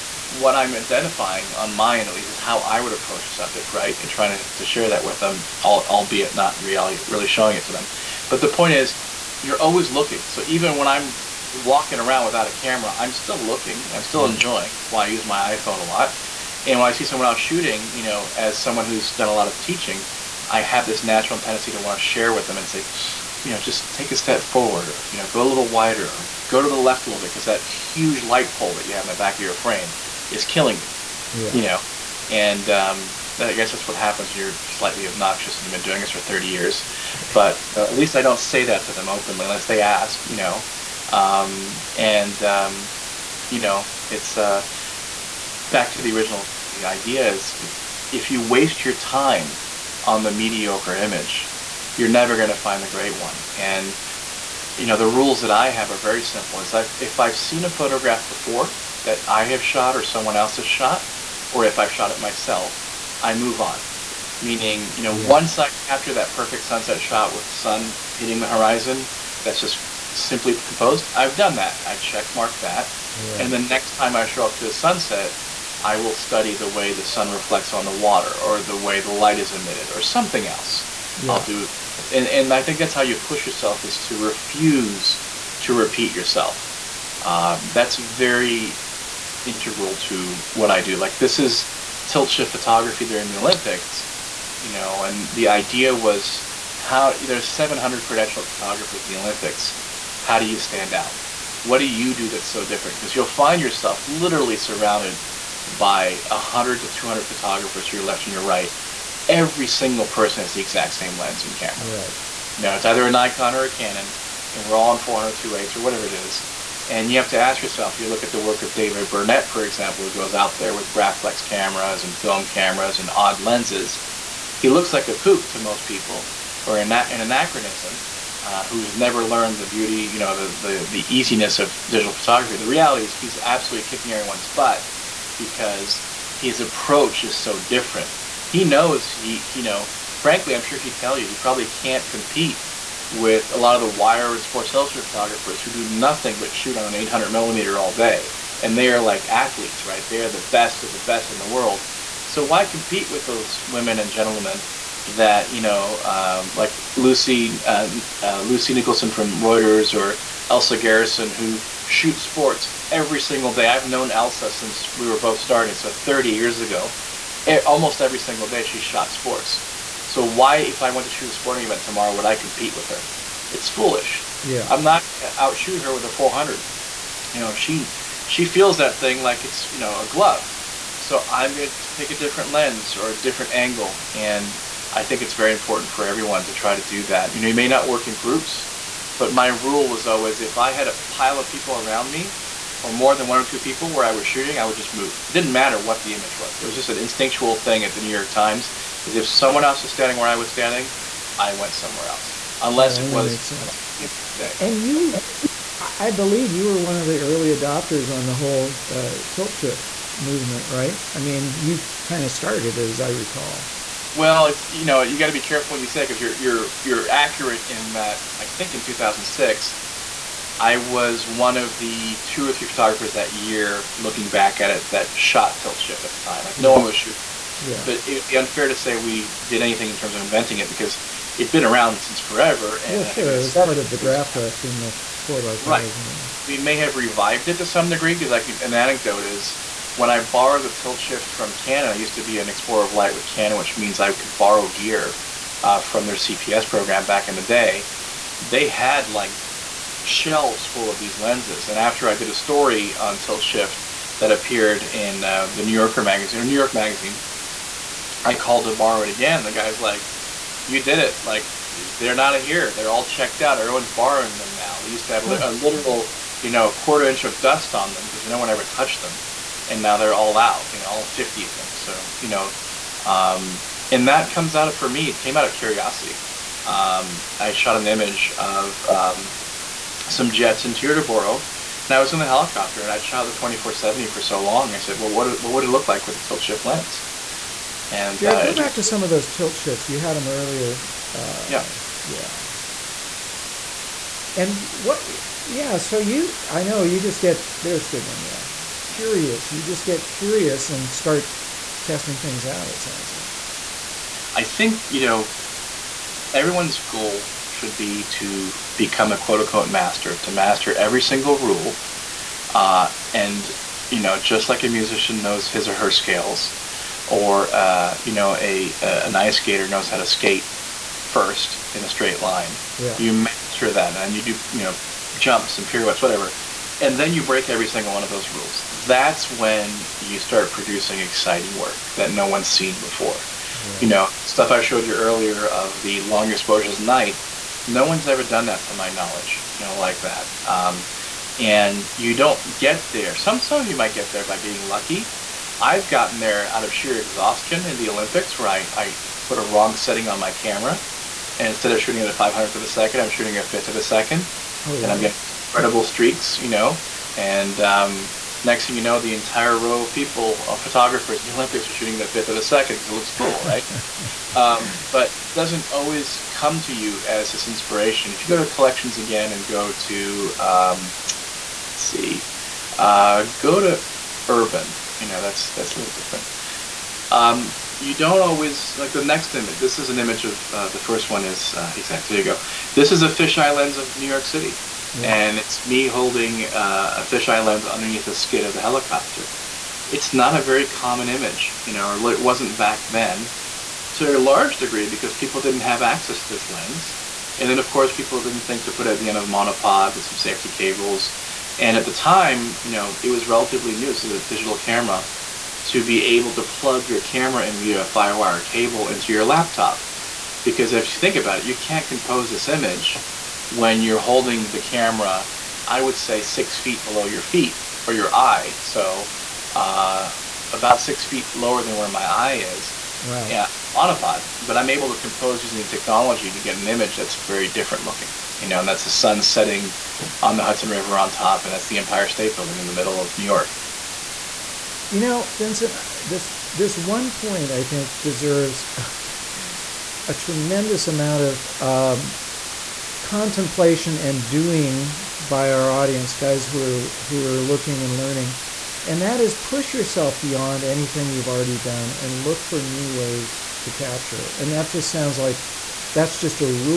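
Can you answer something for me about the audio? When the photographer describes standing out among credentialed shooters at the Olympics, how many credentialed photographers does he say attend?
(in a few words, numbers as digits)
700.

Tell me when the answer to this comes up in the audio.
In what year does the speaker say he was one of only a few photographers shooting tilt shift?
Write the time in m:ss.
3:38.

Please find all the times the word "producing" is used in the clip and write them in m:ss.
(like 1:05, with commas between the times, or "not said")
5:30.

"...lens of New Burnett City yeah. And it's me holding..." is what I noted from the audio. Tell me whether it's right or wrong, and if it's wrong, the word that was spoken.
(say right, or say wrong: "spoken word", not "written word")
wrong: "York", not "Burnett".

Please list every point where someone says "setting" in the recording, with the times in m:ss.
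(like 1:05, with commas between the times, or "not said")
5:49, 7:09.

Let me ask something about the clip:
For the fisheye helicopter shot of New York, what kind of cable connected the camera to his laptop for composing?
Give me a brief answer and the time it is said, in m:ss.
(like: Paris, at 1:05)
firewire, at 6:47.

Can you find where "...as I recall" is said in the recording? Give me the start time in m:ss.
3:32.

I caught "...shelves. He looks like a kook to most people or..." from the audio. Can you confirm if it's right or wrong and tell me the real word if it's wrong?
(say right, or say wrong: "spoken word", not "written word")
wrong: "lenses", not "shelves".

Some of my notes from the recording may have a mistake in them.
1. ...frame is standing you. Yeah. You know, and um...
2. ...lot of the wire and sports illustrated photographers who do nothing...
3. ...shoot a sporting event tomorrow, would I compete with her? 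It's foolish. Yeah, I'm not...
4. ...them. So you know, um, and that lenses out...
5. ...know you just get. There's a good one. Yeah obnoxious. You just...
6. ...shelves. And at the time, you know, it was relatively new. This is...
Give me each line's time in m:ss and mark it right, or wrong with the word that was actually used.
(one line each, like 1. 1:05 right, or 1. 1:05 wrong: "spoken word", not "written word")
1. 0:29 wrong: "killing", not "standing"
2. 2:23 right
3. 2:51 right
4. 4:31 wrong: "comes", not "lenses"
5. 4:56 wrong: "curious", not "obnoxious"
6. 6:40 wrong: "cables", not "shelves".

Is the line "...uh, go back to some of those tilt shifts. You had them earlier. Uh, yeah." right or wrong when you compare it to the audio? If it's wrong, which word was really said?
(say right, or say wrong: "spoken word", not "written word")
right.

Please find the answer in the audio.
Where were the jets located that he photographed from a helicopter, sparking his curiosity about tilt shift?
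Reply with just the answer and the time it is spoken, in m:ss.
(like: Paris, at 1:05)
Teterboro, at 4:40.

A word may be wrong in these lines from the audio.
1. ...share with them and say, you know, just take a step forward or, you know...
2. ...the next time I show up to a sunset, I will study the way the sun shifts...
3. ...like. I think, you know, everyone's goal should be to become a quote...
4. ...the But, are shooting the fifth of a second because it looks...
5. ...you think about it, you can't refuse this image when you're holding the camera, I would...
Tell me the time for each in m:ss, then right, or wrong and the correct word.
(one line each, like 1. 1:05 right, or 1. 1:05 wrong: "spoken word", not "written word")
1. 0:22 right
2. 1:13 wrong: "reflects", not "shifts"
3. 5:03 right
4. 6:01 wrong: "Olympics", not "But"
5. 6:50 wrong: "compose", not "refuse".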